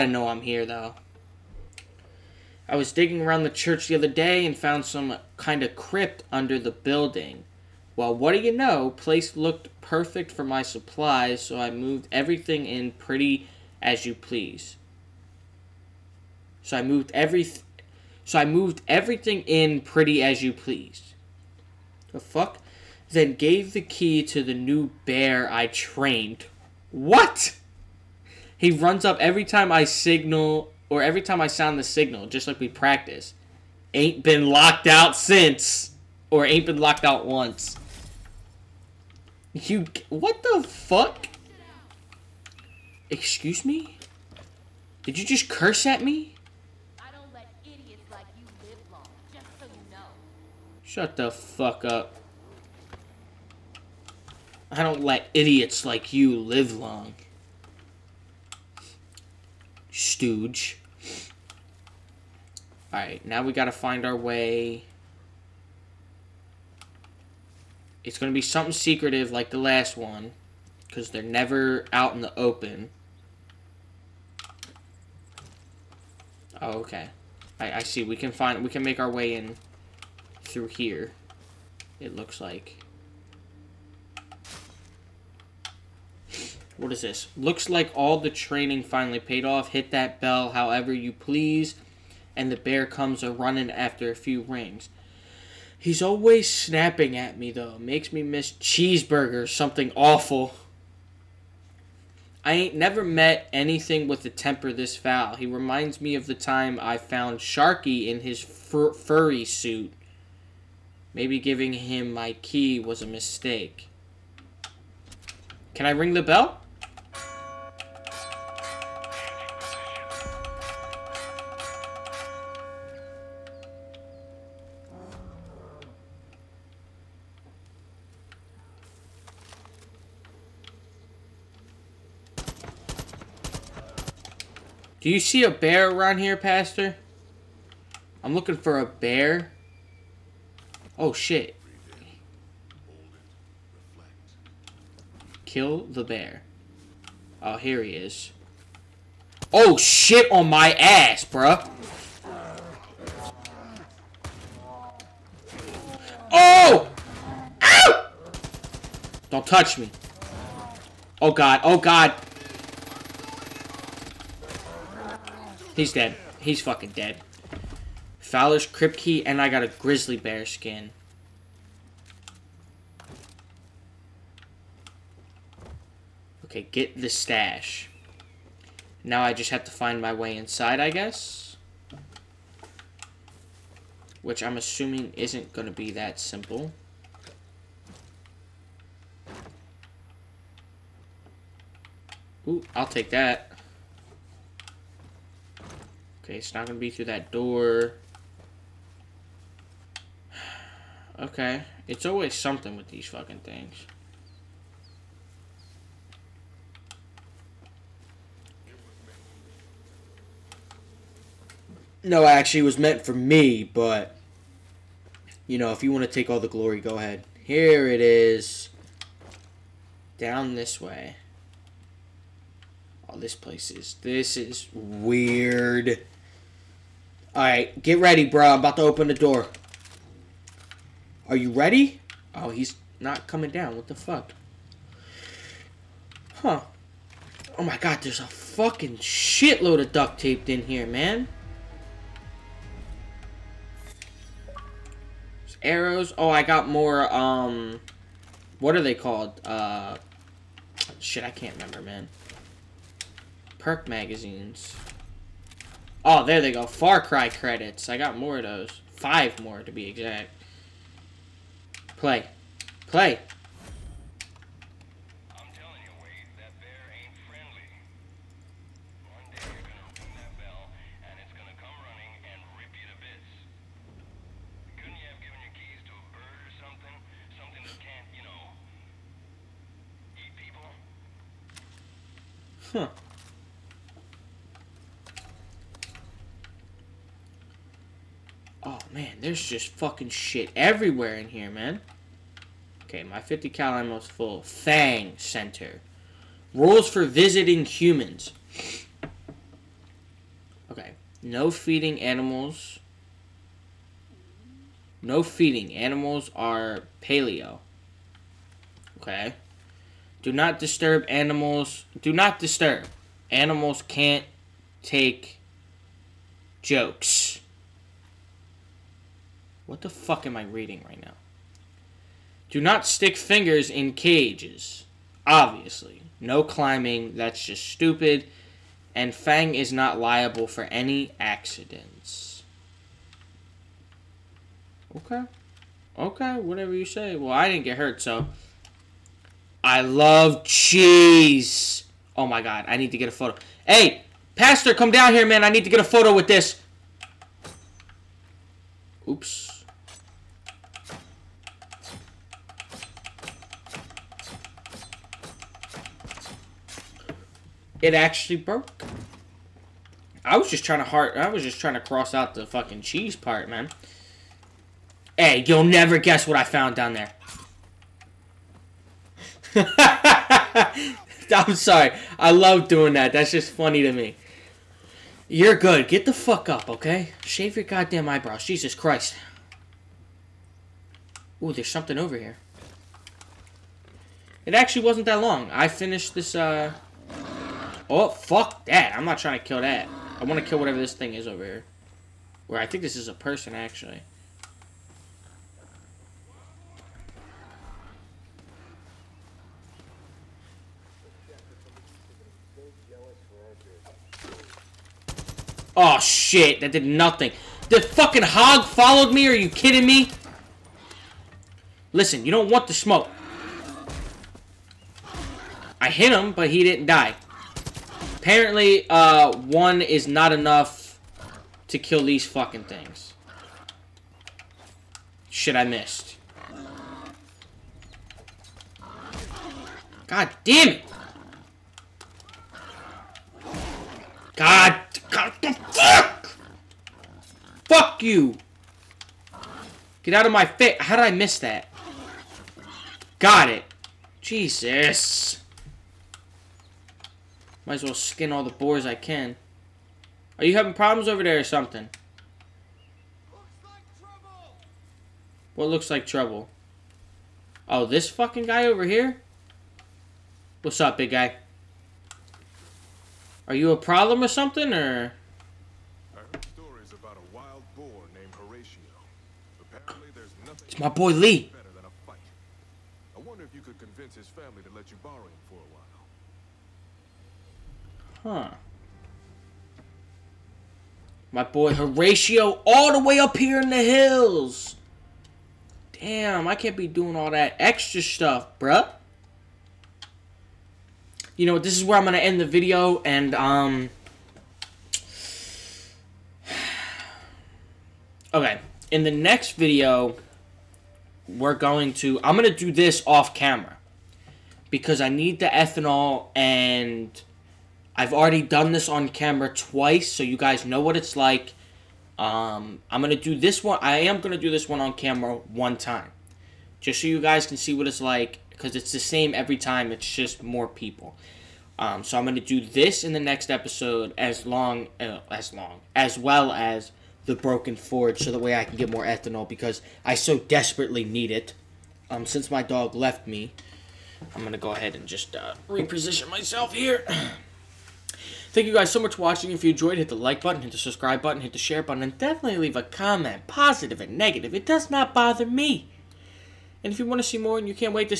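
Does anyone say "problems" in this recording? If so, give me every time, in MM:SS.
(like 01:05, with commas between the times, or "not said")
07:30, 07:43.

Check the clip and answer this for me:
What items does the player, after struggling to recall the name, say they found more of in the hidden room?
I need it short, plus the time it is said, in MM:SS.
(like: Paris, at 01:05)
Perk magazines, at 04:13.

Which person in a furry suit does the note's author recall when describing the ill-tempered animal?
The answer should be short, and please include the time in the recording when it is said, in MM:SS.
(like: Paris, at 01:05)
Sharky, at 01:47.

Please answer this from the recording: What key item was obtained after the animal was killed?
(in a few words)
Fowler's Crypt Key.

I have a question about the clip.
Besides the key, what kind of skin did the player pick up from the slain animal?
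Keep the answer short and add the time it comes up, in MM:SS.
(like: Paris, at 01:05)
Grizzly bear skin, at 02:49.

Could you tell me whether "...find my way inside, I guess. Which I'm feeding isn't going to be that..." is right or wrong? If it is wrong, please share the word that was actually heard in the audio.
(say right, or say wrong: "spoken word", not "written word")
wrong: "assuming", not "feeding".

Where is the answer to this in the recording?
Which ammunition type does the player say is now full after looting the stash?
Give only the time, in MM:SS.
04:53.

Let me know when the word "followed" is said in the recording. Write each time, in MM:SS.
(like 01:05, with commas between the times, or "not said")
06:48.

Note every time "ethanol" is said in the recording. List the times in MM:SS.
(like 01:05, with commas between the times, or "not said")
08:25, 08:49.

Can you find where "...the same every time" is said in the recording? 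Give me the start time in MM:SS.
08:38.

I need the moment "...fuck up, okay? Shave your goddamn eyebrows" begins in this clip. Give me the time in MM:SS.
06:16.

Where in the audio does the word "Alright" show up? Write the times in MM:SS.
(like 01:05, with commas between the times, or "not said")
01:02, 03:47.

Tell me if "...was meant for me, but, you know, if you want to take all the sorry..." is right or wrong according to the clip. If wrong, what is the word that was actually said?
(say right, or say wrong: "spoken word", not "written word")
wrong: "glory", not "sorry".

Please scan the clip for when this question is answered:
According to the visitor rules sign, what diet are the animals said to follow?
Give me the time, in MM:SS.
05:07.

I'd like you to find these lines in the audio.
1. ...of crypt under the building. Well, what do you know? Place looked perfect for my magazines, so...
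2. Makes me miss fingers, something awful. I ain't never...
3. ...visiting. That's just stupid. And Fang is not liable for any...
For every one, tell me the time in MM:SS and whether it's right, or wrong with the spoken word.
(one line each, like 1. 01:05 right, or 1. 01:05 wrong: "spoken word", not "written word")
1. 00:05 wrong: "supplies", not "magazines"
2. 01:37 wrong: "cheeseburgers", not "fingers"
3. 05:26 wrong: "climbing", not "visiting".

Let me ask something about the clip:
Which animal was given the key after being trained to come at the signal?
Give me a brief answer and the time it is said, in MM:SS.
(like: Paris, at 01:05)
The new bear, at 00:24.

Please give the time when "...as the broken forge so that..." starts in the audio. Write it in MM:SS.
08:46.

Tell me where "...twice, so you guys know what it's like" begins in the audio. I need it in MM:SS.
08:29.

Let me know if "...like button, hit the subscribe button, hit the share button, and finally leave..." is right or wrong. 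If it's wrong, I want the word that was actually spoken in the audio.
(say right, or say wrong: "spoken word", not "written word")
wrong: "definitely", not "finally".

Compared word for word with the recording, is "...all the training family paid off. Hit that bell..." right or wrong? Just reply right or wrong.
wrong.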